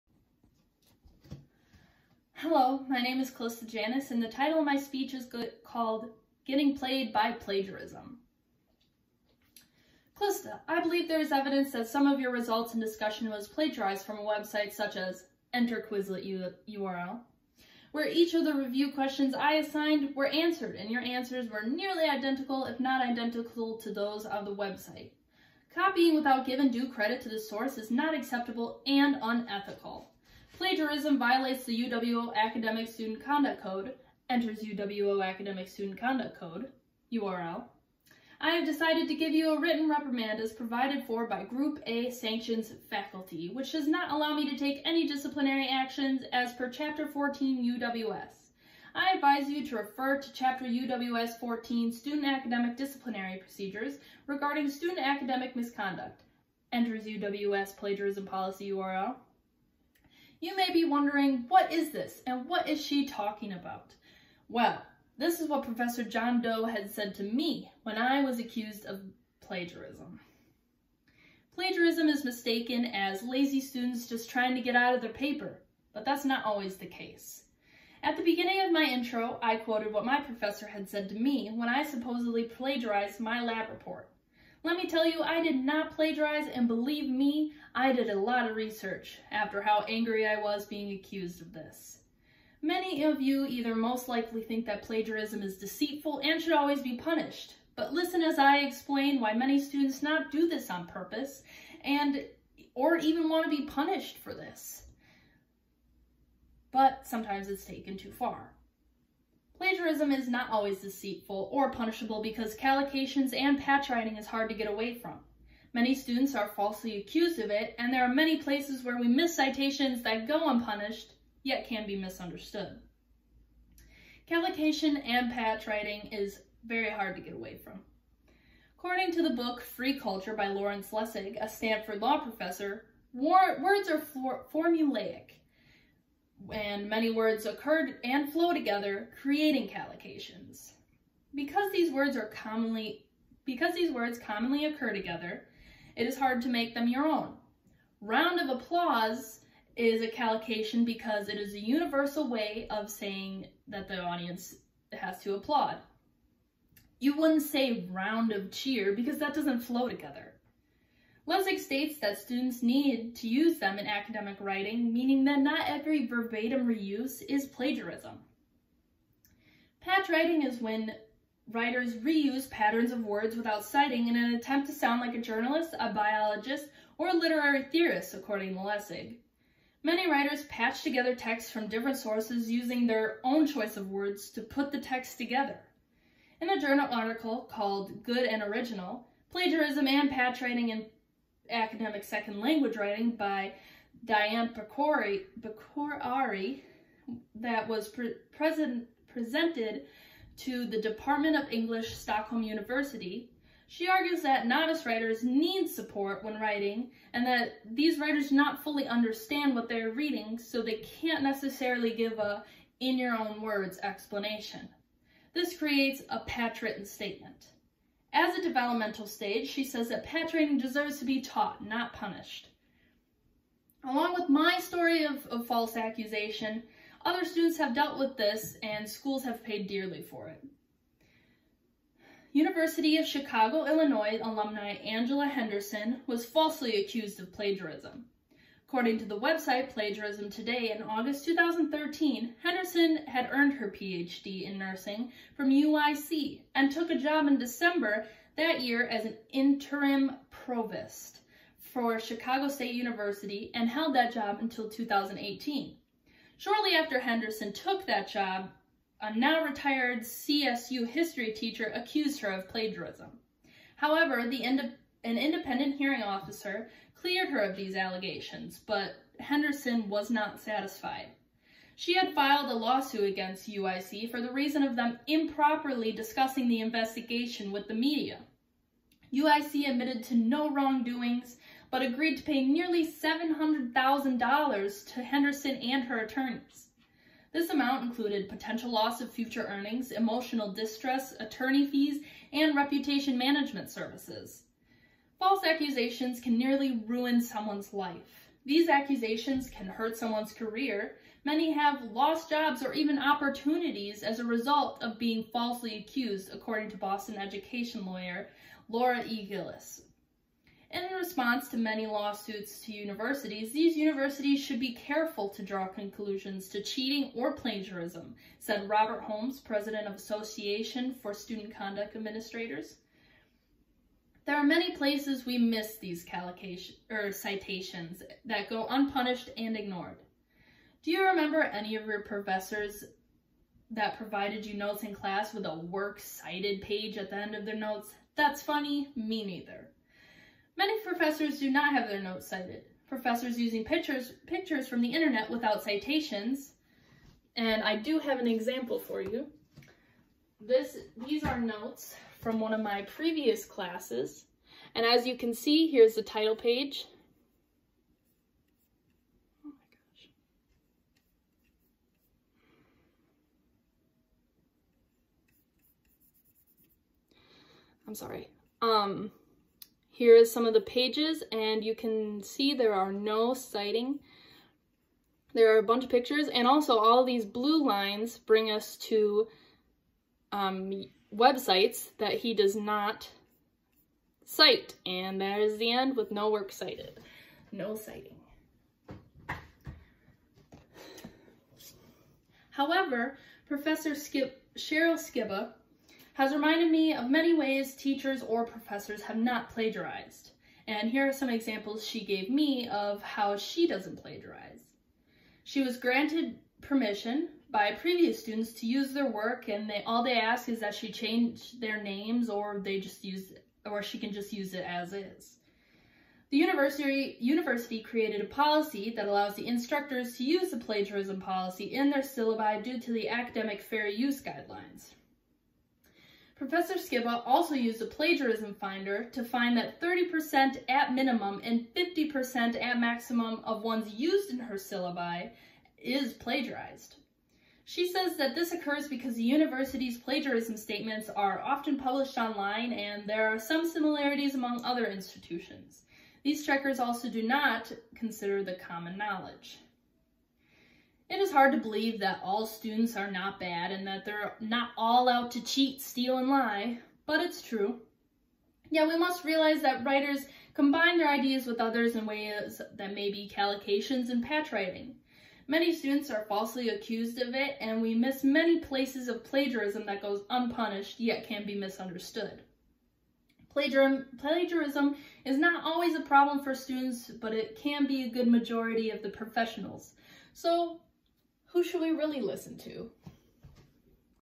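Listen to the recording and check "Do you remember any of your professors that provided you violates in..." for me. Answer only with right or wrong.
wrong.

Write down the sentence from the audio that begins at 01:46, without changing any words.
But sometimes it's taken too far.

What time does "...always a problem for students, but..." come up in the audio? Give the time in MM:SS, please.
07:55.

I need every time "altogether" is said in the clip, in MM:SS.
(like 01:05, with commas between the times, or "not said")
not said.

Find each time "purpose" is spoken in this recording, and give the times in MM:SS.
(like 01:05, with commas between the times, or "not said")
01:40.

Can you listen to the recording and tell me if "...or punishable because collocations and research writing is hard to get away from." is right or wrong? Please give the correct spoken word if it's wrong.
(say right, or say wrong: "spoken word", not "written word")
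wrong: "patch", not "research".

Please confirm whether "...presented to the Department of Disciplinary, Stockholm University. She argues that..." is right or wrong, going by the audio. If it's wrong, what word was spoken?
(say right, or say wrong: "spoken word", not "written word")
wrong: "English", not "Disciplinary".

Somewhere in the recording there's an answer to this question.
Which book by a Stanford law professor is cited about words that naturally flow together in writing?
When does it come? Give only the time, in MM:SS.
02:09.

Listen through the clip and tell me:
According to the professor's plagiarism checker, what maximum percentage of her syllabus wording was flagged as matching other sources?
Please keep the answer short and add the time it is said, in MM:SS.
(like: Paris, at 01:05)
50%, at 07:11.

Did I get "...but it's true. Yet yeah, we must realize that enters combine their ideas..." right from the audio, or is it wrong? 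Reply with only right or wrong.
wrong.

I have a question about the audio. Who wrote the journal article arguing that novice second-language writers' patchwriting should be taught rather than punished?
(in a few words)
Diane Pecorari.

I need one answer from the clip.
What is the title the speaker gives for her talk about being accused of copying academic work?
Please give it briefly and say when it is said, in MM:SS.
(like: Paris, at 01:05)
Getting Played by Plagiarism, at 00:06.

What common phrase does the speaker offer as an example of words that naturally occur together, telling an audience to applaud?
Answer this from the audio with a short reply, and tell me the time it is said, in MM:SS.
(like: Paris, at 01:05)
Round of applause, at 02:27.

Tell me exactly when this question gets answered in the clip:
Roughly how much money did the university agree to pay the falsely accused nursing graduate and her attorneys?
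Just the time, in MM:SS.
04:42.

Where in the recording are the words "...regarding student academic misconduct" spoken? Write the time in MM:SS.
00:54.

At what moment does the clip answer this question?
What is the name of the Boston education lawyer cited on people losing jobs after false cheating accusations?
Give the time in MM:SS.
05:08.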